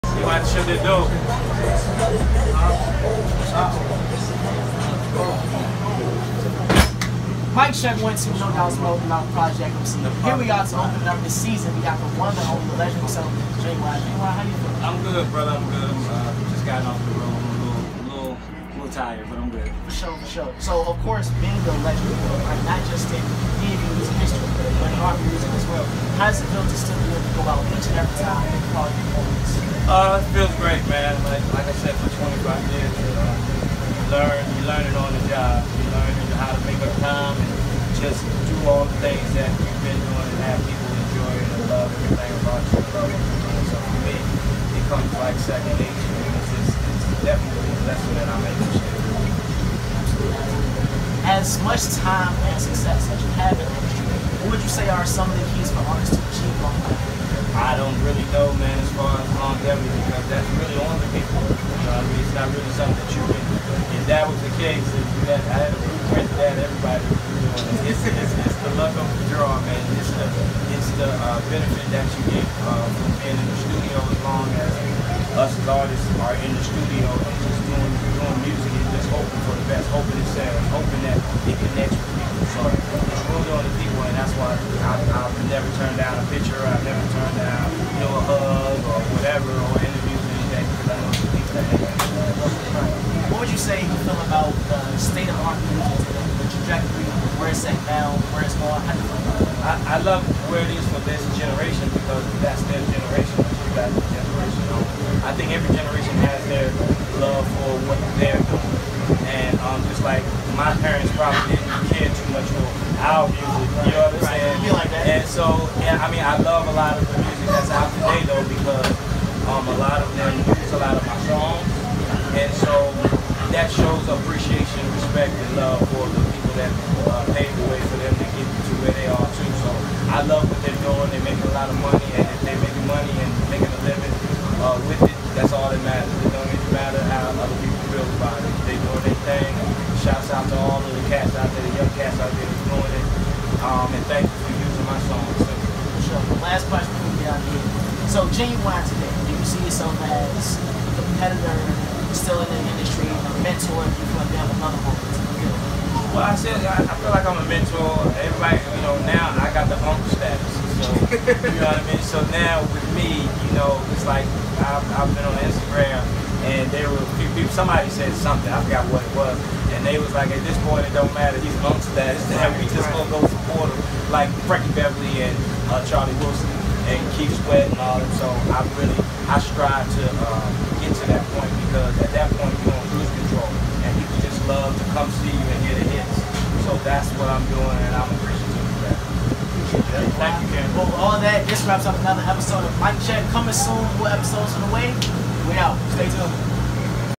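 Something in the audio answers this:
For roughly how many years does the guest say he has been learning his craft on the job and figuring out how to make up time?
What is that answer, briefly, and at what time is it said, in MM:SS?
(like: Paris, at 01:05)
25 years, at 00:32.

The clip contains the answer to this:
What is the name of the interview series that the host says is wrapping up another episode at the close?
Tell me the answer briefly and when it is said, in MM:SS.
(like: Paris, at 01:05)
Mic Check, at 03:12.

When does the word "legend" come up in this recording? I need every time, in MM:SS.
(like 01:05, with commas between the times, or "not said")
00:12, 00:21.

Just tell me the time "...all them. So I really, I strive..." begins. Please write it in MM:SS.
02:57.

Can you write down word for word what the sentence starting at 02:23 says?
Um, and thank you for using my song.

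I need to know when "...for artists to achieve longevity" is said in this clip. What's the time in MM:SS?
00:55.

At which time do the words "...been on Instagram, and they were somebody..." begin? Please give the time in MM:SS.
02:45.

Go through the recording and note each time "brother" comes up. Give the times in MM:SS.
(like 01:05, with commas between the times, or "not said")
00:15.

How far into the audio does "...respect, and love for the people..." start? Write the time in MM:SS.
02:05.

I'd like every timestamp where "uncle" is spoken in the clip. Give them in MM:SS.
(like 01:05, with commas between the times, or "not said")
02:39.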